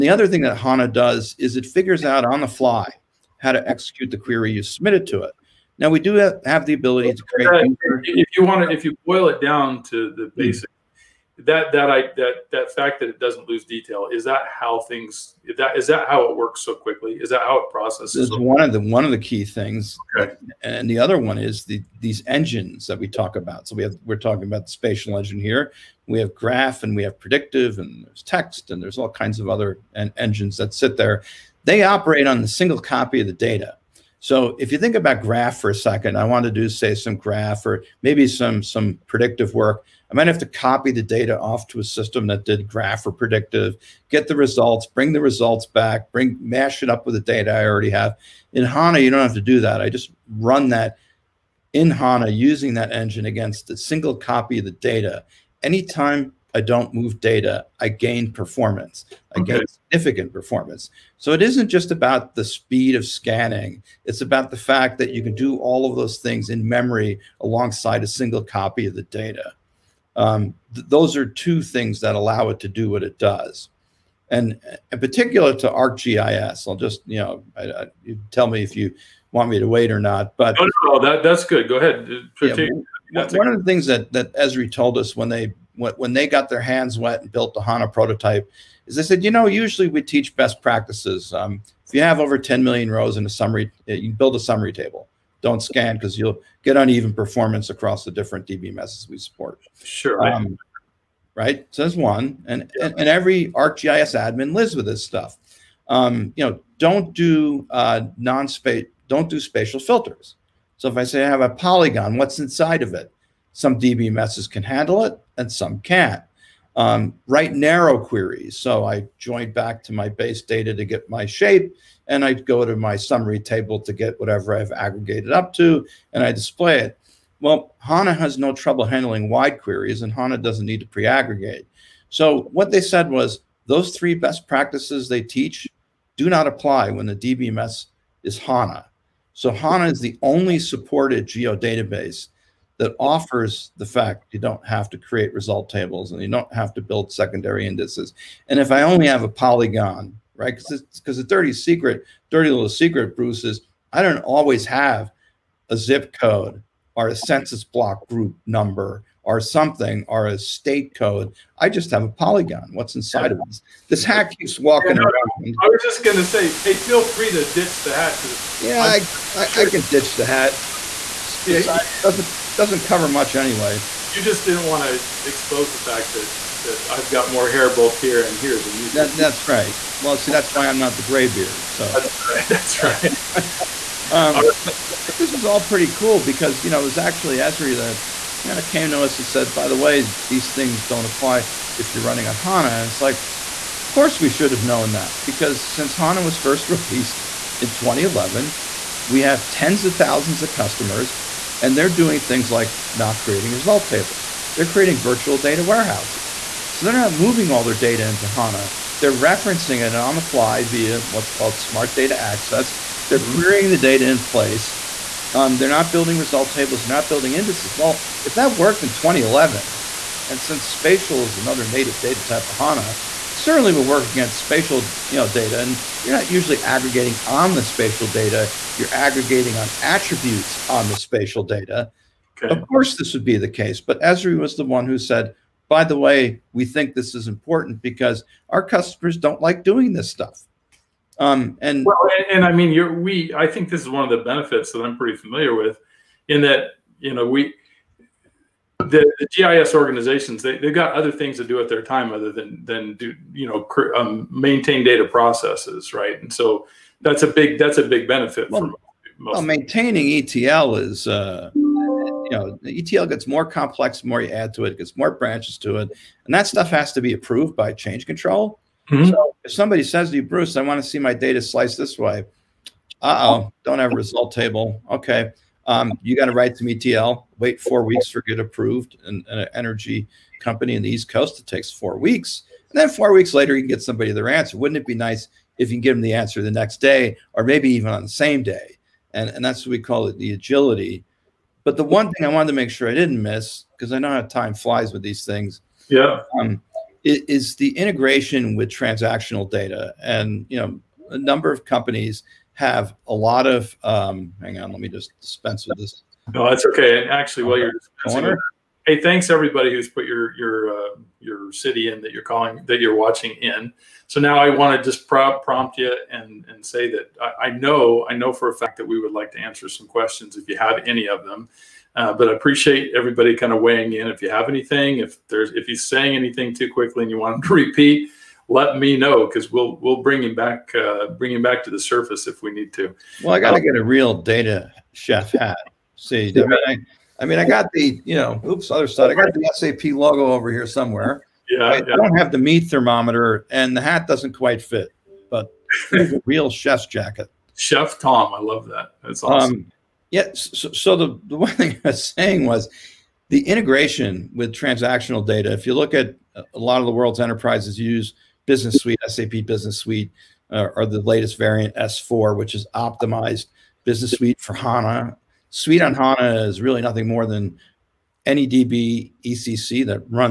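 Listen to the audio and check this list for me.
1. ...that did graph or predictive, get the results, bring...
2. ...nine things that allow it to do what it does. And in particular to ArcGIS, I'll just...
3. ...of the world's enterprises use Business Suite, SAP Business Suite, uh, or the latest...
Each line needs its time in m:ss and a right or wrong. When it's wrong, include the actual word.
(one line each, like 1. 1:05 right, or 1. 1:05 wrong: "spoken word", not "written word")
1. 0:42 right
2. 1:11 wrong: "two", not "nine"
3. 5:56 right.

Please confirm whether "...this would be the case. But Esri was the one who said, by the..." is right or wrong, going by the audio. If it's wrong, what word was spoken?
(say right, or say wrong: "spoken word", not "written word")
right.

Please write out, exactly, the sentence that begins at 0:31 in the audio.
They operate on the single copy of the data.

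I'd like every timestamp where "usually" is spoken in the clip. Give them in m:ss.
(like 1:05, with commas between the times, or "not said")
1:29, 3:46.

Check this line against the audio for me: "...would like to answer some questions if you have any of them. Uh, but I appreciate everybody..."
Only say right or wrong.
right.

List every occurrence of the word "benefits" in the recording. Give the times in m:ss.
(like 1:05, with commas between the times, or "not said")
4:04, 4:18.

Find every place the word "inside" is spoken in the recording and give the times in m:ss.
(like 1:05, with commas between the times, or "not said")
1:52, 2:42.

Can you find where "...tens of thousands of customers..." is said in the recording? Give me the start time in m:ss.
3:19.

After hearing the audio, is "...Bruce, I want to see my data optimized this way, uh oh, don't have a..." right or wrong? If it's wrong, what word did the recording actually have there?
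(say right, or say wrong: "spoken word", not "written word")
wrong: "sliced", not "optimized".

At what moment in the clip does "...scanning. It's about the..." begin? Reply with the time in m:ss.
1:03.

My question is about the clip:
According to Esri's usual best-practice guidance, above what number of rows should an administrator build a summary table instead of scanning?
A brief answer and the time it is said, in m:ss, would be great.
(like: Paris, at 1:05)
10 million, at 1:32.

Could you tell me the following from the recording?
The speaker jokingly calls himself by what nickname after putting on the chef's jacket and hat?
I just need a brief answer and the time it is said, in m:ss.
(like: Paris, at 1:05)
Chef Tom, at 5:47.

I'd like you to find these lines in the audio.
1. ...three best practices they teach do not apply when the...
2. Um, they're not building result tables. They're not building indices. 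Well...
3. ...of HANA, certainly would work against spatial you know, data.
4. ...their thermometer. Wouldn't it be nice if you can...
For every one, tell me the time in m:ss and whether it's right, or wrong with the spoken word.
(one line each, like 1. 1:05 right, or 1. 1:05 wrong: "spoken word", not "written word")
1. 2:13 right
2. 3:35 right
3. 3:42 right
4. 4:44 wrong: "answer", not "thermometer".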